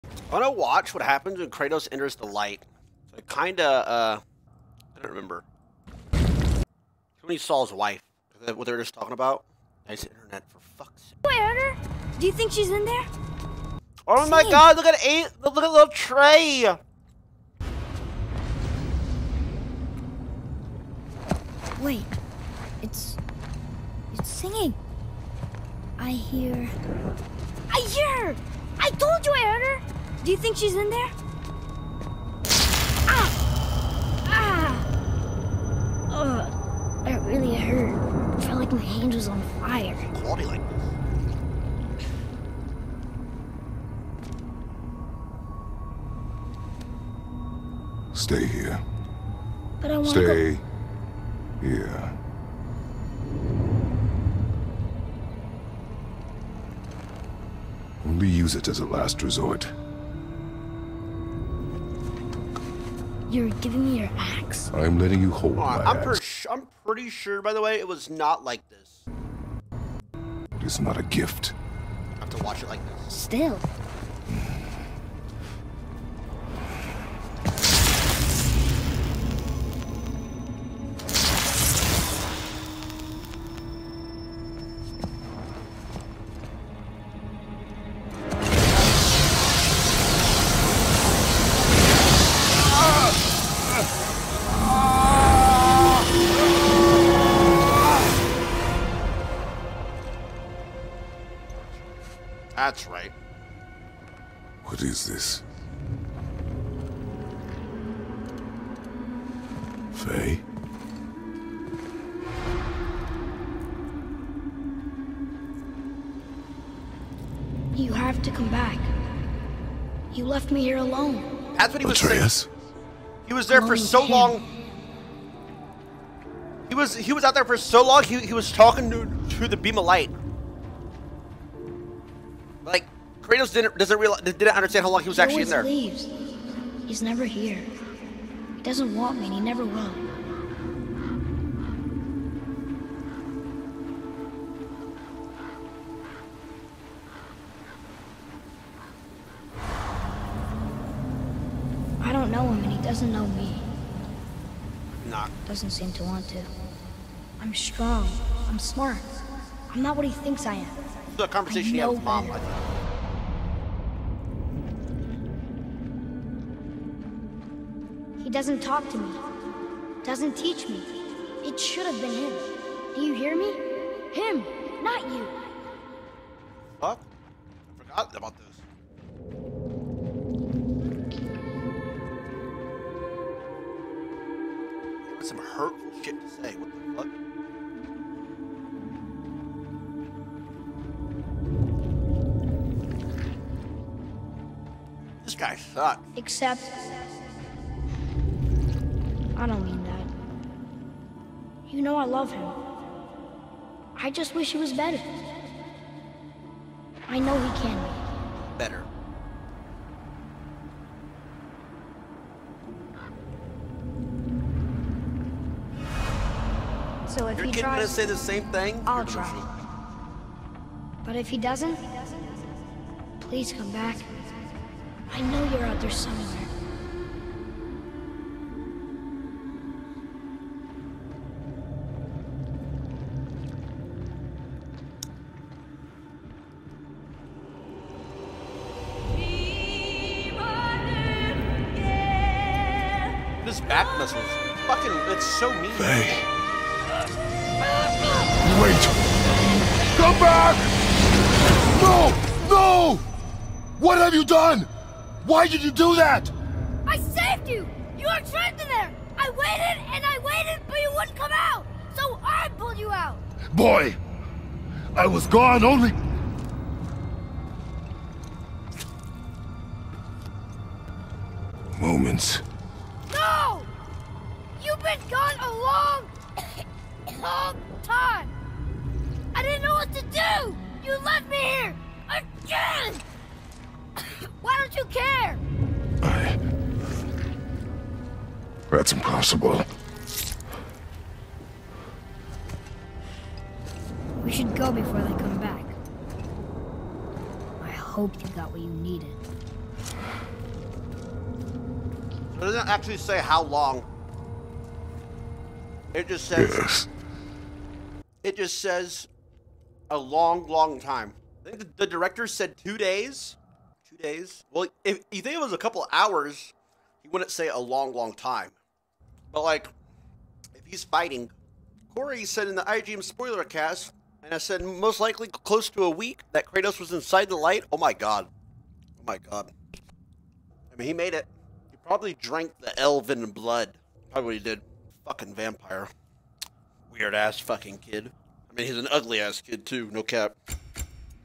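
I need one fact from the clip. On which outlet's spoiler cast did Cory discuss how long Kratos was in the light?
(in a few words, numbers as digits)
IGN.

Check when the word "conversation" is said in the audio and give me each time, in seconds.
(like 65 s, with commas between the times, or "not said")
161 s.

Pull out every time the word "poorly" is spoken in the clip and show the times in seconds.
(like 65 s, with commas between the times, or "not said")
not said.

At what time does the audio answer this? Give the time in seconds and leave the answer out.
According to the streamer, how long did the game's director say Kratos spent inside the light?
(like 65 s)
312 s.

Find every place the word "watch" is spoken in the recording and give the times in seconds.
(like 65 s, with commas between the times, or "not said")
0 s, 72 s.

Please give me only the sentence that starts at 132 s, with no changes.
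Like, Kratos didn't doesn't realize didn't understand how long he was he actually in there.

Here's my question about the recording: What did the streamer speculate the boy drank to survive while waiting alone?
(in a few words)
elven blood.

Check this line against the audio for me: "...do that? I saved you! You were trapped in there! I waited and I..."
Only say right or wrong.
right.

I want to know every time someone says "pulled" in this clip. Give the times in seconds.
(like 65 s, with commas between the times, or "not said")
262 s.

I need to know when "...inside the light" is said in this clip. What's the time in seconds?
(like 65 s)
326 s.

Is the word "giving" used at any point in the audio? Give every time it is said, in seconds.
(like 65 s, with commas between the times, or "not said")
63 s.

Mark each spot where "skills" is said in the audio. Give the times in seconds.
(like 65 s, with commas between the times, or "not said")
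not said.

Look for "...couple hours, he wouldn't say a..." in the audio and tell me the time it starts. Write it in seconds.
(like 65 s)
315 s.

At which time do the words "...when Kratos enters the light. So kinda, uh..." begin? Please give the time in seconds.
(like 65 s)
1 s.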